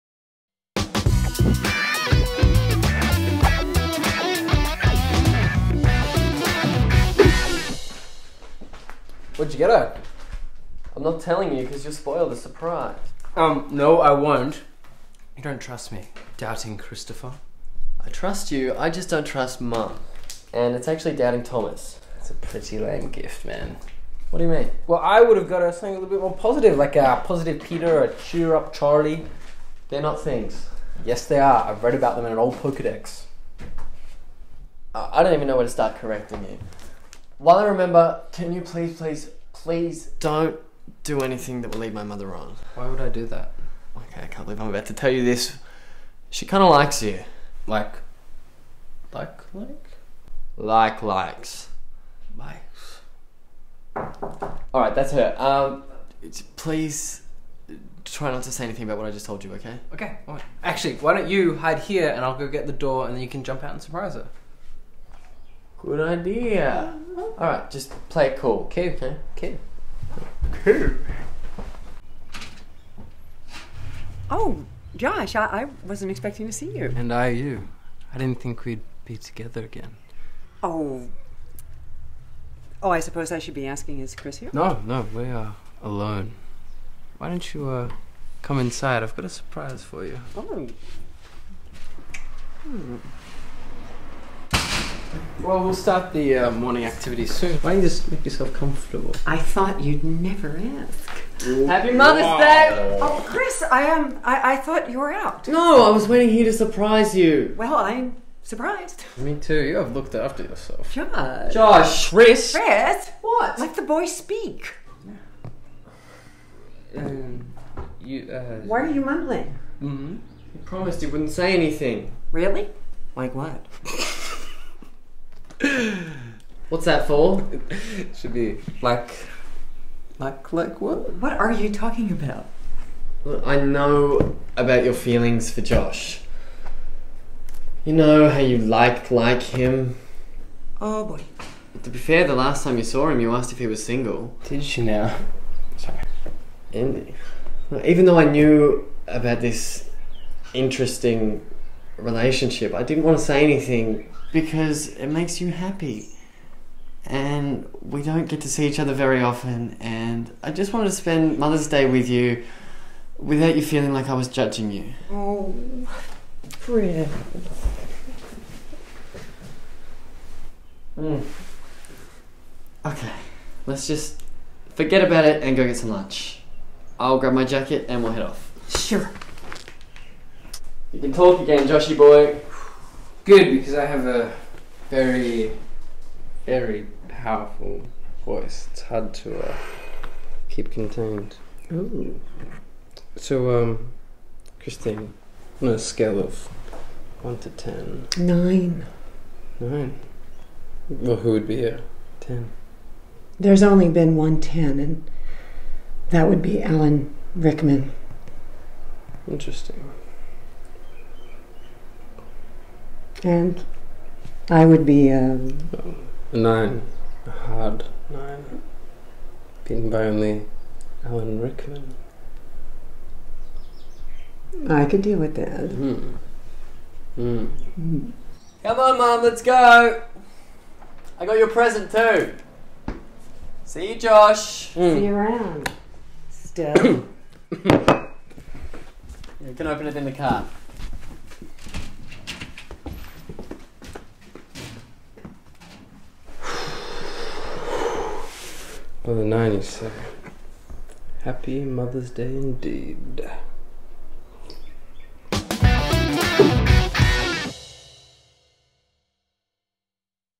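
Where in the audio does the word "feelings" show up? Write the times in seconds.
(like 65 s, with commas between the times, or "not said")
134 s, 163 s.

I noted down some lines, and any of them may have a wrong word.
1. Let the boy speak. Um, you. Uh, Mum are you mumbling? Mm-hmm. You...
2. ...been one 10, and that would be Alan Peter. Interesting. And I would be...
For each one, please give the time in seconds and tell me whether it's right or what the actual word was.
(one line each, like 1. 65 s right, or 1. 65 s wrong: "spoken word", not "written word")
1. 113 s wrong: "Why", not "Mum"
2. 203 s wrong: "Rickman", not "Peter".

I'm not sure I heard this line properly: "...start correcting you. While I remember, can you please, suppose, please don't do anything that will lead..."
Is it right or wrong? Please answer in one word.
wrong.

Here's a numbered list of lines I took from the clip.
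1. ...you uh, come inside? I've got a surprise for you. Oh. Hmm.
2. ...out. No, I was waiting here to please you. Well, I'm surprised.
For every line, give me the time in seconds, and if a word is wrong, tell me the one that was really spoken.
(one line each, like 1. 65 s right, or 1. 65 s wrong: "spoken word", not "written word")
1. 87 s right
2. 105 s wrong: "surprise", not "please".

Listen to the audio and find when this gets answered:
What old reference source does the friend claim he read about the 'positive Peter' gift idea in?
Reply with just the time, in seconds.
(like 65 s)
32 s.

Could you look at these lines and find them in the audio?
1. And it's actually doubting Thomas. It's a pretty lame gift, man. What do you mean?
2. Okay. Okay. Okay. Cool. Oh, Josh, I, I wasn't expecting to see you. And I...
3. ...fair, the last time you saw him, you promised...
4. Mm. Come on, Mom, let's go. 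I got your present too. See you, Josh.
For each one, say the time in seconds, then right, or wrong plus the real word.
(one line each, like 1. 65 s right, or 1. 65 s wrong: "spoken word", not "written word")
1. 20 s right
2. 68 s right
3. 141 s wrong: "asked", not "promised"
4. 227 s right.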